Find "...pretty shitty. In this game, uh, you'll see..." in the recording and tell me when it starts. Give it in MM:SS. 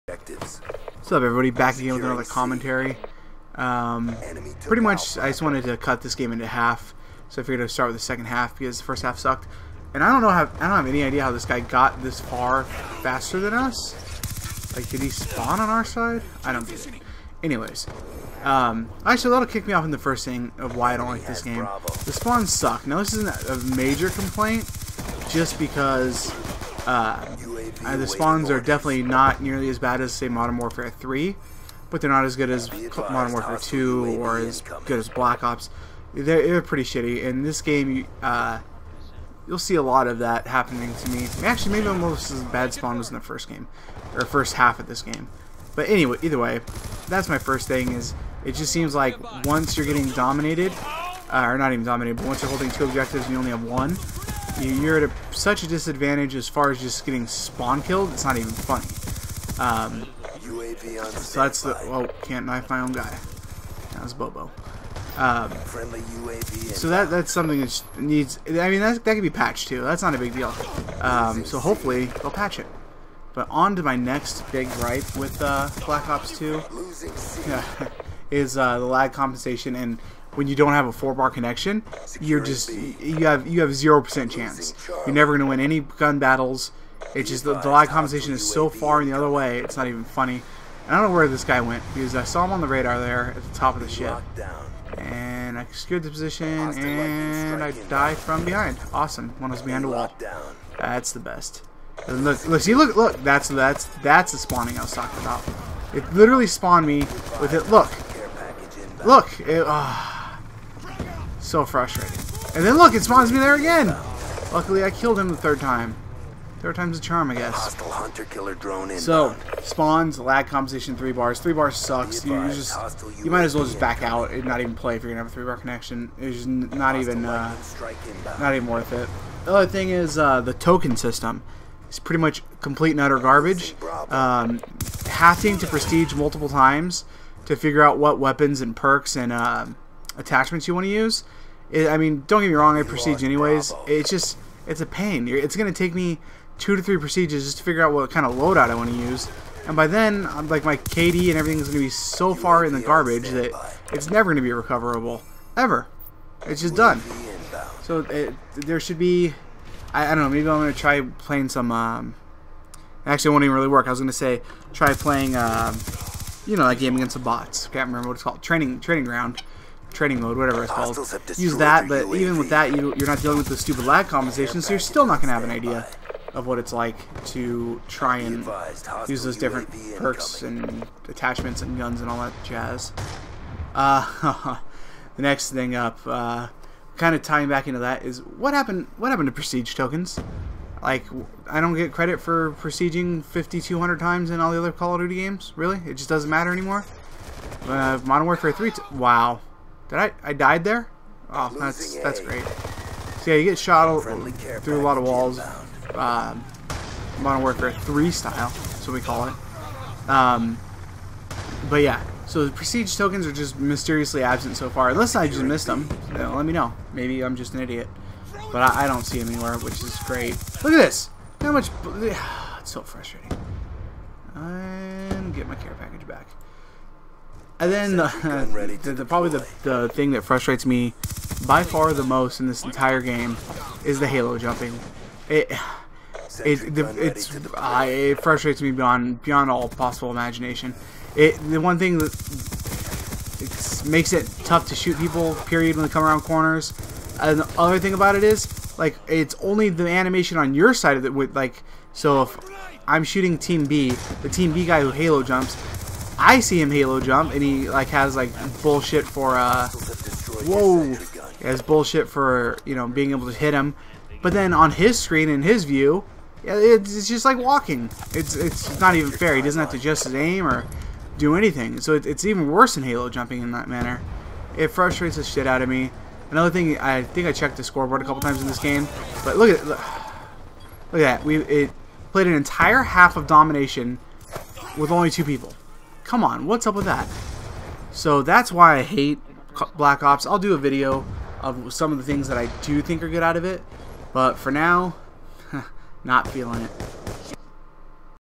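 00:36.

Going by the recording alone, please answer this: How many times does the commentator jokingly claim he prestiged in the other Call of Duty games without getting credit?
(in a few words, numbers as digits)
5,200.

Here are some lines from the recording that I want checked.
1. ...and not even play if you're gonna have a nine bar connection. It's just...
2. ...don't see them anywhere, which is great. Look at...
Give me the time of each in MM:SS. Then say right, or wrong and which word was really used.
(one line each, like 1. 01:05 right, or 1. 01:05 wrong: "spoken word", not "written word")
1. 02:04 wrong: "three", not "nine"
2. 03:38 right.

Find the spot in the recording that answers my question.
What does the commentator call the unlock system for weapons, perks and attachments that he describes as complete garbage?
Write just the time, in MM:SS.
02:10.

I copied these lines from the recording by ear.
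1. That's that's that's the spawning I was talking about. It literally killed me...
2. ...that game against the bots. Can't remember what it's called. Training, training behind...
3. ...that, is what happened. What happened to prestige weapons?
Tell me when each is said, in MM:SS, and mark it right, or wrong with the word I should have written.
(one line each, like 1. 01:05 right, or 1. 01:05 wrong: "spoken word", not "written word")
1. 01:43 wrong: "spawned", not "killed"
2. 02:46 wrong: "ground", not "behind"
3. 03:07 wrong: "tokens", not "weapons".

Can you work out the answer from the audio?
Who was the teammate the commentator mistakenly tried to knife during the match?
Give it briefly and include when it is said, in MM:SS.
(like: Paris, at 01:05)
Bobo, at 01:04.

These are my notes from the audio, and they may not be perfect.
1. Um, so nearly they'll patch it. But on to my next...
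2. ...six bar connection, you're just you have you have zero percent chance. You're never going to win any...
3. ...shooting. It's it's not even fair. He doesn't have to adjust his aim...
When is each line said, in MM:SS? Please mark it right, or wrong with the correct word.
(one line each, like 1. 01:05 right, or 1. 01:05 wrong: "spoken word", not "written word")
1. 01:11 wrong: "hopefully", not "nearly"
2. 01:20 wrong: "four", not "six"
3. 04:27 wrong: "walking", not "shooting".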